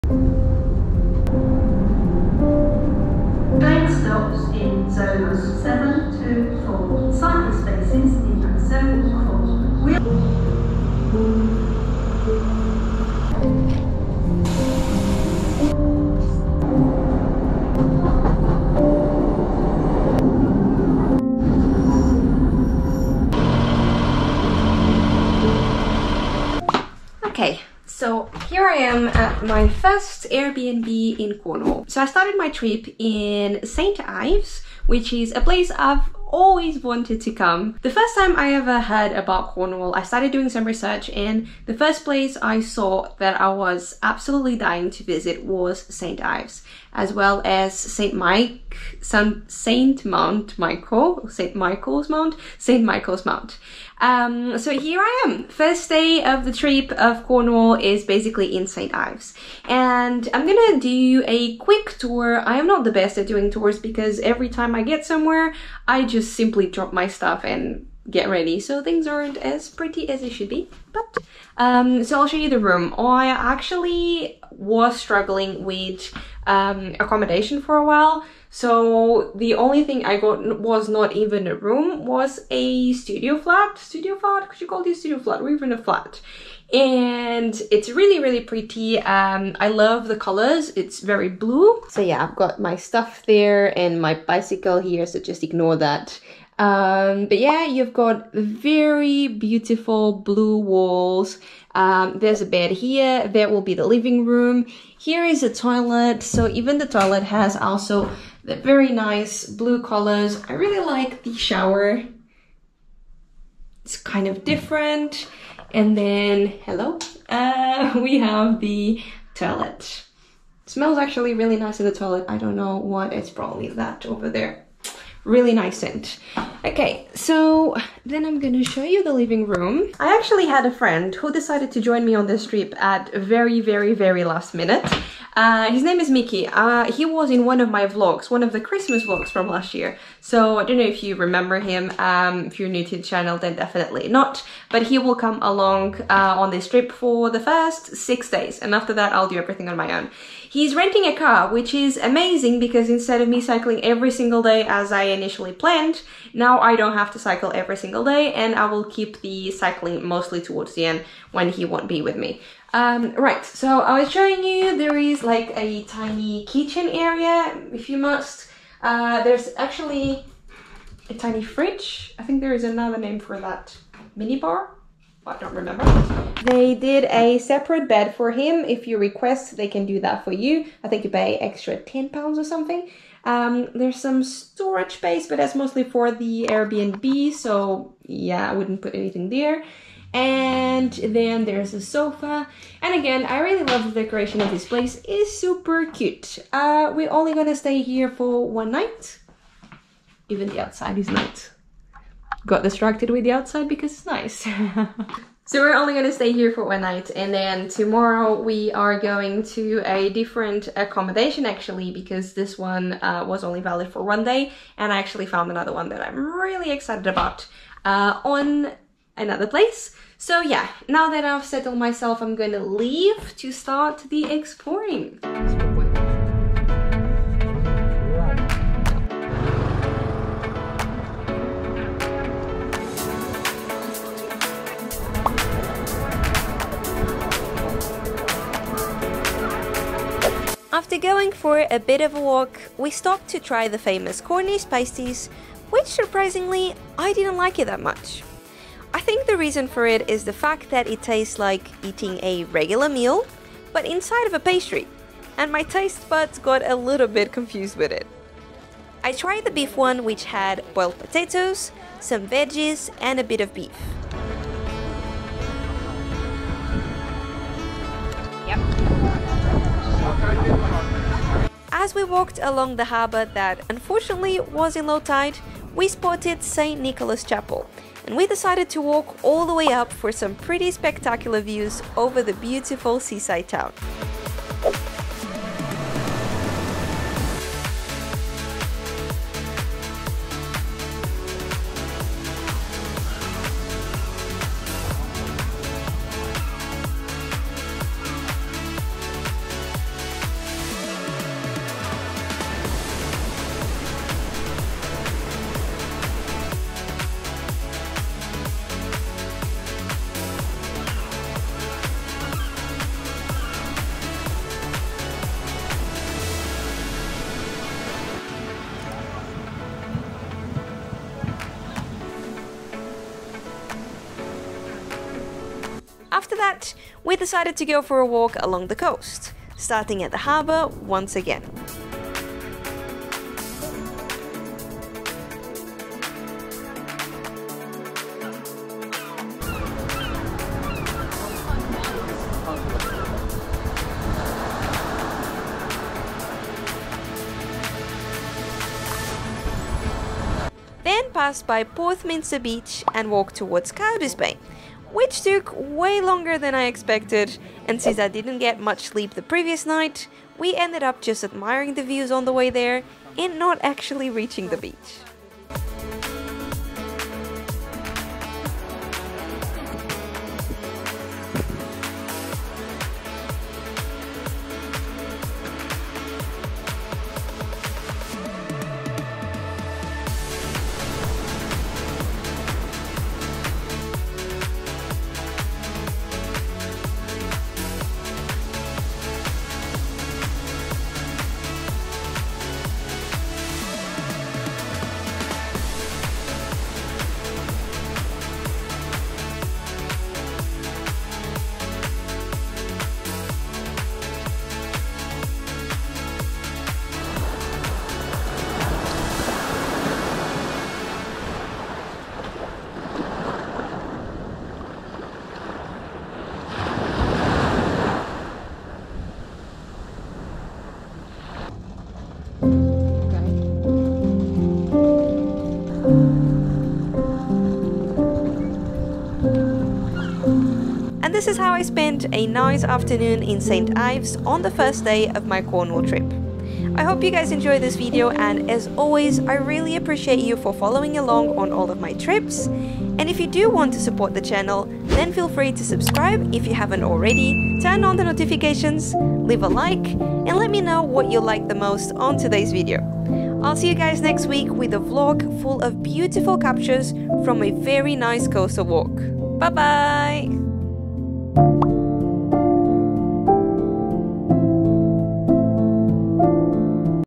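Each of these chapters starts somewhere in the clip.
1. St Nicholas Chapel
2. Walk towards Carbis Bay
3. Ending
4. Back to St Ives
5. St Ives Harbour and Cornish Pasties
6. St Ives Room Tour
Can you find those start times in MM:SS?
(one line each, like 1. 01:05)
1. 04:40
2. 05:25
3. 07:11
4. 06:47
5. 03:45
6. 01:00.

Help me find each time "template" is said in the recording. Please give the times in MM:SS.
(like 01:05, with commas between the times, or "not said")
not said.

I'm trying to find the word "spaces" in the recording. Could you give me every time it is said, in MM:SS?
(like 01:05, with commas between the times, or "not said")
00:07, 03:04.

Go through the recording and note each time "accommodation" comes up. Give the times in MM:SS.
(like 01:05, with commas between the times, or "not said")
01:16, 03:30.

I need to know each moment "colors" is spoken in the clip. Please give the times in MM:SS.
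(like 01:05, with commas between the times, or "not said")
01:30, 01:49.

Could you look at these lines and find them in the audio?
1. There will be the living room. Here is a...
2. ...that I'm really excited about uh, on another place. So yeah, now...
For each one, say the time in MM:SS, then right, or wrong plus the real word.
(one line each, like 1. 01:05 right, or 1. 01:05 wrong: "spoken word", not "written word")
1. 01:43 right
2. 03:35 right.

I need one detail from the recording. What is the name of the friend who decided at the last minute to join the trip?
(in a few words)
Mickey.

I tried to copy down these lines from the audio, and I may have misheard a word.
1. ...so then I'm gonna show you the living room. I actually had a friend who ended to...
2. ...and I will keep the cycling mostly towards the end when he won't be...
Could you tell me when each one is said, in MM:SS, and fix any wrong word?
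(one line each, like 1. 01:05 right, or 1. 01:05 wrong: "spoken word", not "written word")
1. 02:07 wrong: "decided", not "ended"
2. 02:38 right.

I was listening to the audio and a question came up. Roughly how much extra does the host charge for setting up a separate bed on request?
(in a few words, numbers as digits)
10 pounds.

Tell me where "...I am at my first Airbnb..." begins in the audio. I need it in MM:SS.
00:28.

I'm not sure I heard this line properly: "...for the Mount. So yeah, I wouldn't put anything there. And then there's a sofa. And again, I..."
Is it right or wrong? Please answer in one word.
wrong.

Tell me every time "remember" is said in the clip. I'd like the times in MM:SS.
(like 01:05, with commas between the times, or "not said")
02:21, 02:55.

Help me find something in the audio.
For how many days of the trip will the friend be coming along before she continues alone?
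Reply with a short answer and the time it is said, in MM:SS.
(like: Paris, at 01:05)
6, at 02:27.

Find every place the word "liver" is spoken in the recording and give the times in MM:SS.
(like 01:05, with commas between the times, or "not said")
not said.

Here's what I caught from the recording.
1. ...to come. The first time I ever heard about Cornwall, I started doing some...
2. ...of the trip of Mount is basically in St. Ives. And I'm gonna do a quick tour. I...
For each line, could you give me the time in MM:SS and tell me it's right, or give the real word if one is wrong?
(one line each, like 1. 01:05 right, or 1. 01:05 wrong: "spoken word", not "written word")
1. 00:37 right
2. 00:56 wrong: "Cornwall", not "Mount".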